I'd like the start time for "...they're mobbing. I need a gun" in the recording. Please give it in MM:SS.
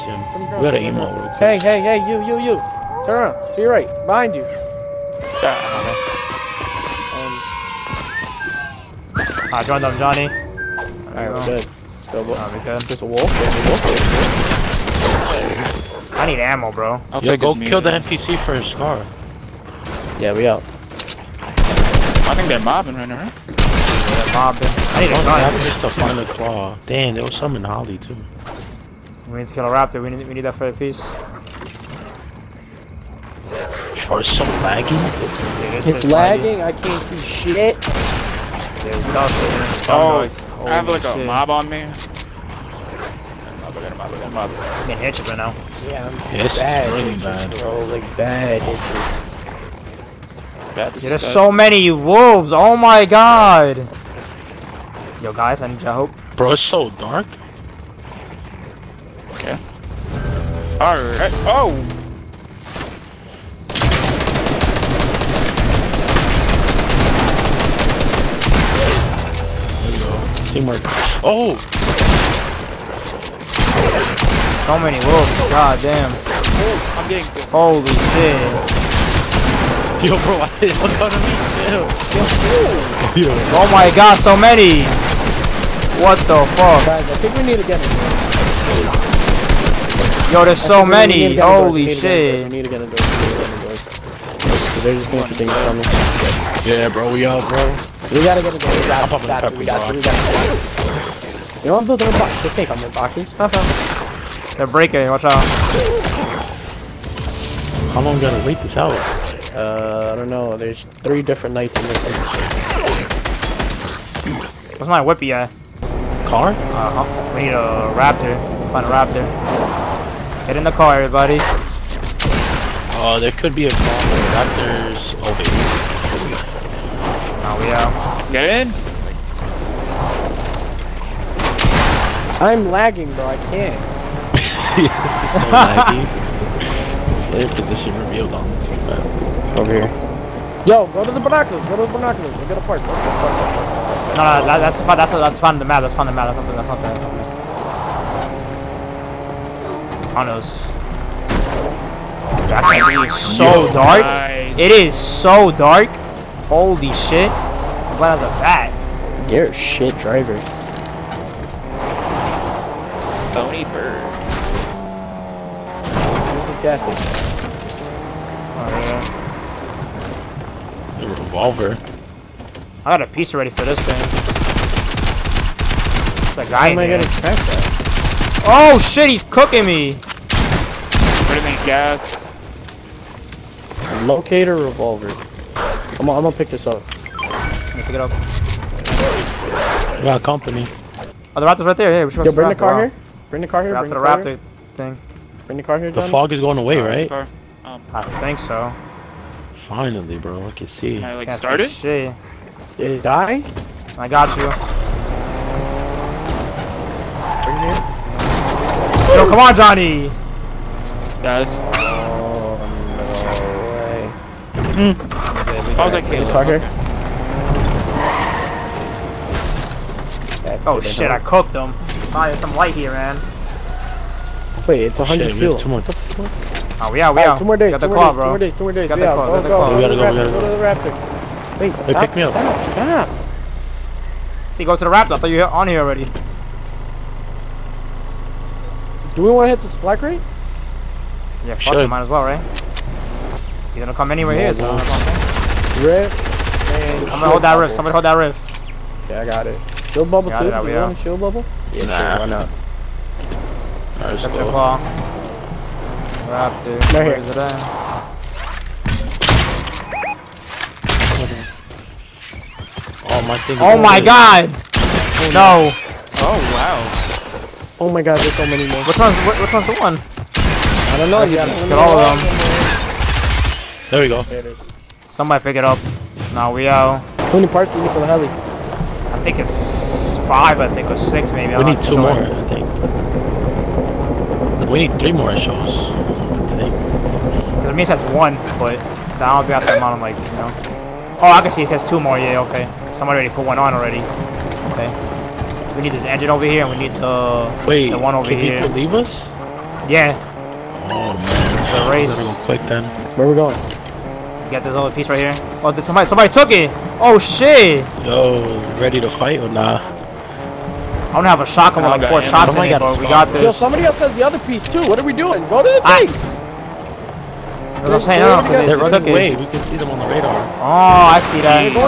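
00:23.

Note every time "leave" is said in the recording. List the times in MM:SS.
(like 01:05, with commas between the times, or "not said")
04:58.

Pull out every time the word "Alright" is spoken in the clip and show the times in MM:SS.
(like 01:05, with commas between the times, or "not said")
00:10, 01:00.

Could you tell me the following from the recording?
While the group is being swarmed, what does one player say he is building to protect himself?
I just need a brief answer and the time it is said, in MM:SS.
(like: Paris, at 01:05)
A box, at 01:41.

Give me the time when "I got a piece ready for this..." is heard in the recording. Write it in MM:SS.
02:52.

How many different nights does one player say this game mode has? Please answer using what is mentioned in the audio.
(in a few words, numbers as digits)
3.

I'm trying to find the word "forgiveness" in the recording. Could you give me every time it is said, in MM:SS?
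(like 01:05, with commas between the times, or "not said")
not said.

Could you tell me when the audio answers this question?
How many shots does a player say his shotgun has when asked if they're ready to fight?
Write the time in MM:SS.
05:12.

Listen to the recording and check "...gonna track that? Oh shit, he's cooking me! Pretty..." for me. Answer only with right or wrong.
right.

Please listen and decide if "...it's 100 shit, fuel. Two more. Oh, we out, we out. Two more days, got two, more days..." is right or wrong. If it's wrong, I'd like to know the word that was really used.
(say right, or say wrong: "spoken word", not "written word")
right.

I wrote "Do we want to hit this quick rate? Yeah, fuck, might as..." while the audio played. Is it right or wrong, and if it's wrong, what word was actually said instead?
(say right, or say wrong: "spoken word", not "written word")
wrong: "black", not "quick".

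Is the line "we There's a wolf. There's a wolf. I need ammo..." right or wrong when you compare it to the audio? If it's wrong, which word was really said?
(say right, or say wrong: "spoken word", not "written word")
right.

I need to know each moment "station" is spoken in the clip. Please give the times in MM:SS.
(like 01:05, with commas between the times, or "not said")
02:46.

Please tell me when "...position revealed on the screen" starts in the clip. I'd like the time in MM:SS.
02:17.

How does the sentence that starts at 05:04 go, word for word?
Get this other piece right here.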